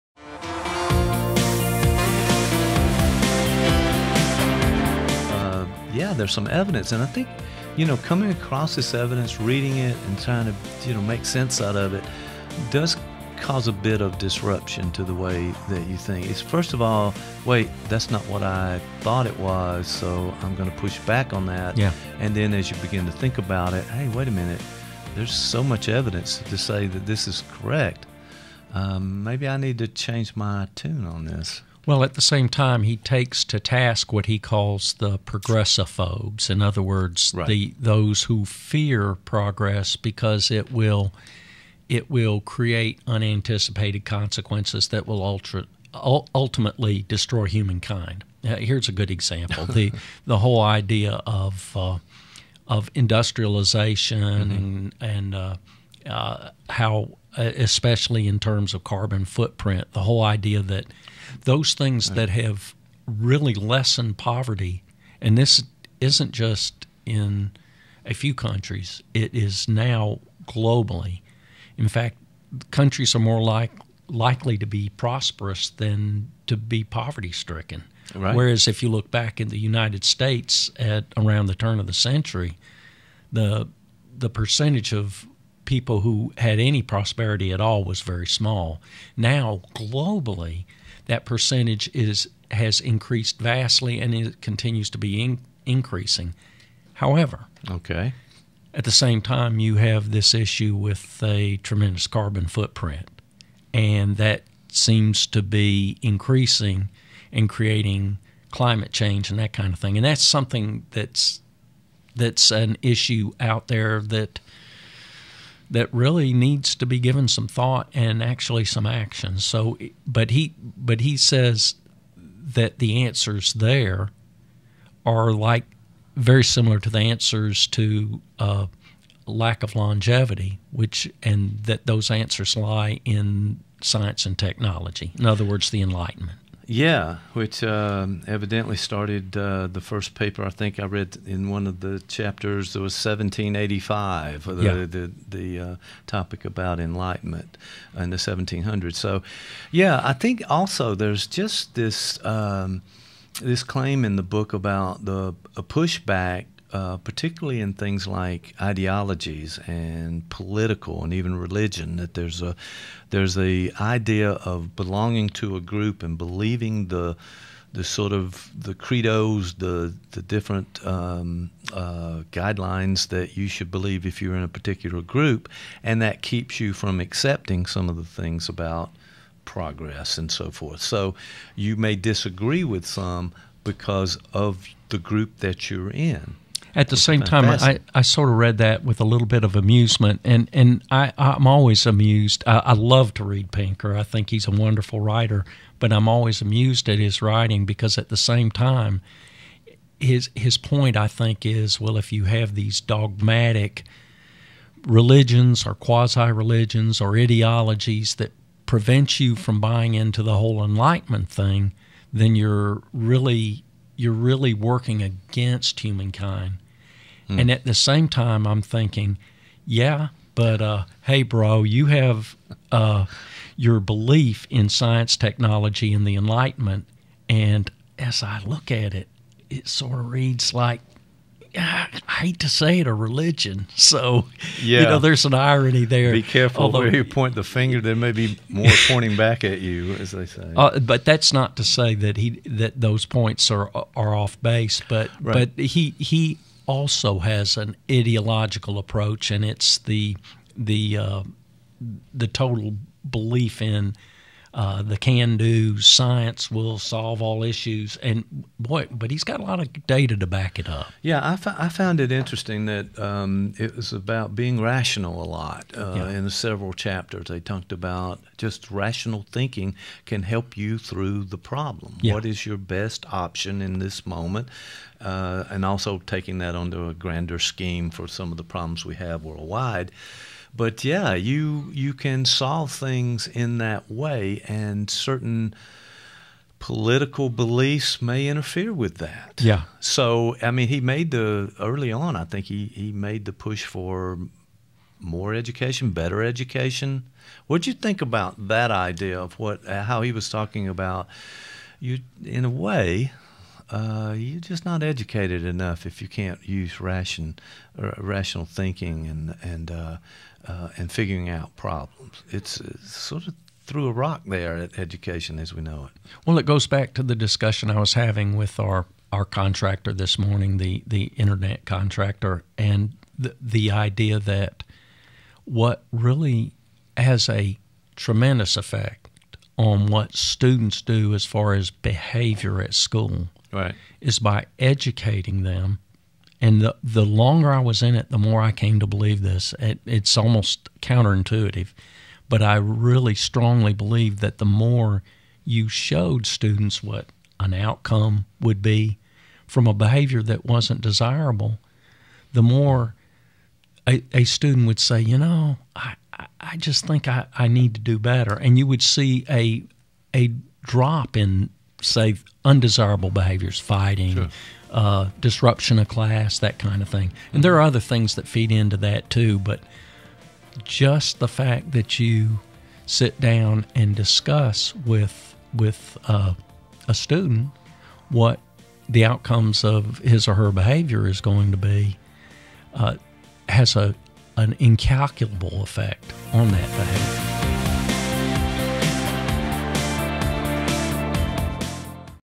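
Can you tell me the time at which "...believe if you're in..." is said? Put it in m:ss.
2:53.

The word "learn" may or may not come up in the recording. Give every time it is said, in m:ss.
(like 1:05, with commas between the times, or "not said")
not said.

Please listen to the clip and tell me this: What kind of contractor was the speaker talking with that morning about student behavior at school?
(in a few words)
internet contractor.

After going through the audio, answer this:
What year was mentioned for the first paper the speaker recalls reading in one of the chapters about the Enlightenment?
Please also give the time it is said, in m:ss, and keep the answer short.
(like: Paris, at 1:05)
1785, at 2:22.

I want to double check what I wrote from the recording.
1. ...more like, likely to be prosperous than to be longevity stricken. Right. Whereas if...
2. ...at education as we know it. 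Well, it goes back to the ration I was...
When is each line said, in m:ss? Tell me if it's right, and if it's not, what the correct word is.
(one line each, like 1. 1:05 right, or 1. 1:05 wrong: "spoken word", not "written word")
1. 1:13 wrong: "poverty", not "longevity"
2. 5:14 wrong: "discussion", not "ration".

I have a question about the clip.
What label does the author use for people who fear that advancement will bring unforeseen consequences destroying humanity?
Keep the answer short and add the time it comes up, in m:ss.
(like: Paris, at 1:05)
progressophobes, at 0:35.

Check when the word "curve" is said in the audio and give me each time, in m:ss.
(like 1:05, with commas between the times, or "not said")
not said.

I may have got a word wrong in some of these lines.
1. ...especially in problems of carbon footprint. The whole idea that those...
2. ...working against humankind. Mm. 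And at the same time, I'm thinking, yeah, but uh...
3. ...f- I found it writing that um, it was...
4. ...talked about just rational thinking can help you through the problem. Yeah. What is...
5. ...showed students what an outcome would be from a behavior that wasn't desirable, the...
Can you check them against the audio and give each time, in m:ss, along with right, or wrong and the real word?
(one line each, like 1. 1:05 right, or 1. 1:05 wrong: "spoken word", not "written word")
1. 0:57 wrong: "terms", not "problems"
2. 3:34 right
3. 4:21 wrong: "interesting", not "writing"
4. 4:27 right
5. 5:45 right.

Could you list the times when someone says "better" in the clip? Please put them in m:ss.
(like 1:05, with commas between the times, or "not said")
4:55, 5:57.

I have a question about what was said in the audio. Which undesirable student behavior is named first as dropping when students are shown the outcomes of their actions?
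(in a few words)
fighting.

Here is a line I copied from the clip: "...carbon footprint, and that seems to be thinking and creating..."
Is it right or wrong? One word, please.
wrong.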